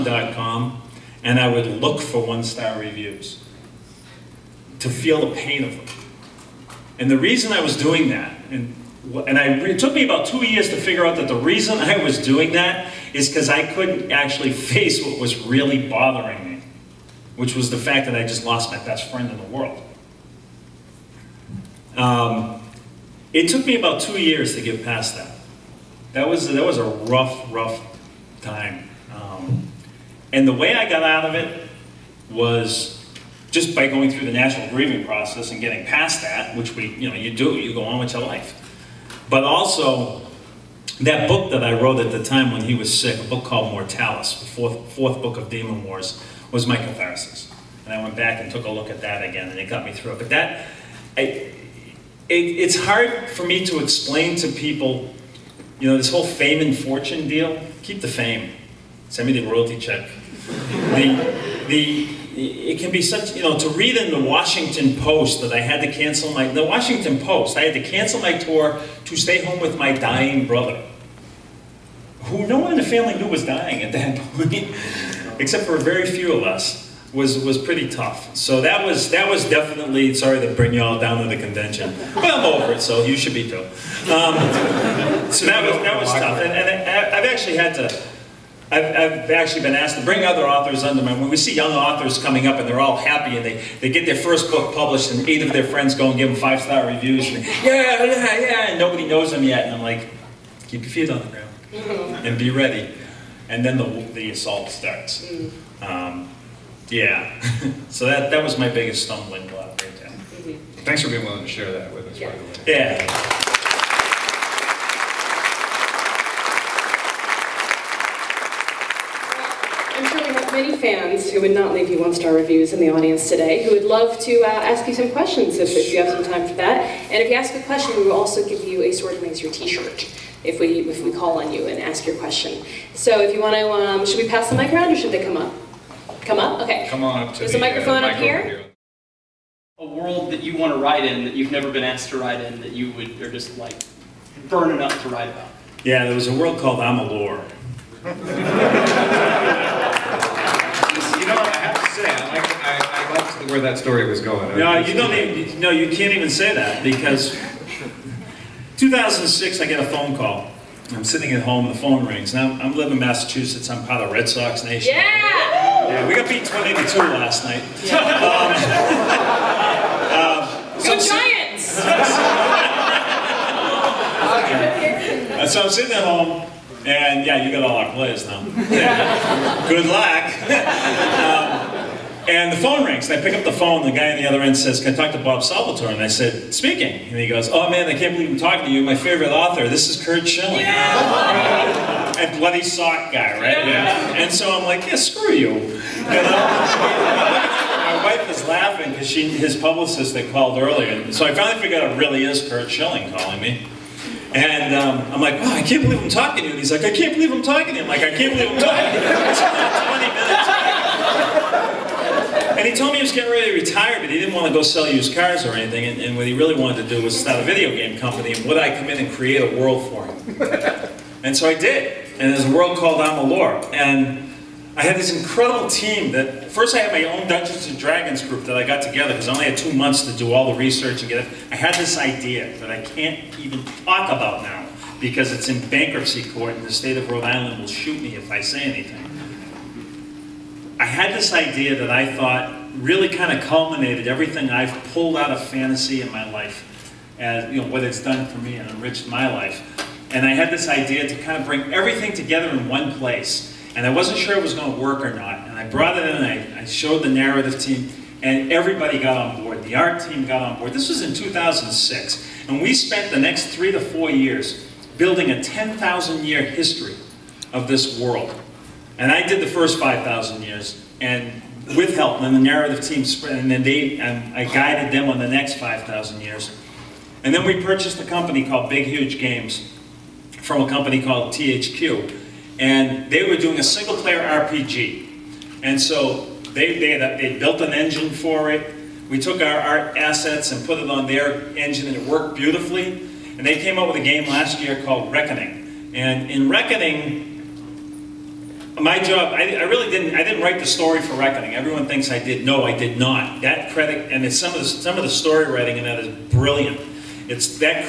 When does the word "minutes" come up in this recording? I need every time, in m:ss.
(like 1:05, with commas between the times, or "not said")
3:30.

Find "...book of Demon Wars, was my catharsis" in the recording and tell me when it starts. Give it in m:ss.
0:45.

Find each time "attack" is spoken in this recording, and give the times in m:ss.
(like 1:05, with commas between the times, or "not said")
not said.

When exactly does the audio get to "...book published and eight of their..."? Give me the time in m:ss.
1:34.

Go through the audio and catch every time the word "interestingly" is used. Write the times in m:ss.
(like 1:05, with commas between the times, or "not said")
not said.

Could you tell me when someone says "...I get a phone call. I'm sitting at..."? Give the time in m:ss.
2:39.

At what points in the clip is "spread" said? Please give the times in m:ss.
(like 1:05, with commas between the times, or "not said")
4:33.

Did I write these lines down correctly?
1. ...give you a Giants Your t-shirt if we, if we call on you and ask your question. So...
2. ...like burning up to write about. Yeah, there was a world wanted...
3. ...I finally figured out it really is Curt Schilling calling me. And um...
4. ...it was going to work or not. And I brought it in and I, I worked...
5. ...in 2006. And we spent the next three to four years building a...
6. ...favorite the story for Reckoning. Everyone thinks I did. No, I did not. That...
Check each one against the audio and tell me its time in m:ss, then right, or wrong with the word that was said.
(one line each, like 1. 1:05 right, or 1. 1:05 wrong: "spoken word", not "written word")
1. 2:08 wrong: "Sword", not "Giants"
2. 2:23 wrong: "called", not "wanted"
3. 3:21 right
4. 4:14 wrong: "showed", not "worked"
5. 4:21 right
6. 5:00 wrong: "write", not "favorite".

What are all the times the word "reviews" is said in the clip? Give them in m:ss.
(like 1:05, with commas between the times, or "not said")
0:02, 1:36, 2:02.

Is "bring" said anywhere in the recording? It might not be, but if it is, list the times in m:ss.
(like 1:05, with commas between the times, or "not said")
1:20, 1:30, 4:11.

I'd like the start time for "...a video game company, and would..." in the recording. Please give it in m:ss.
3:37.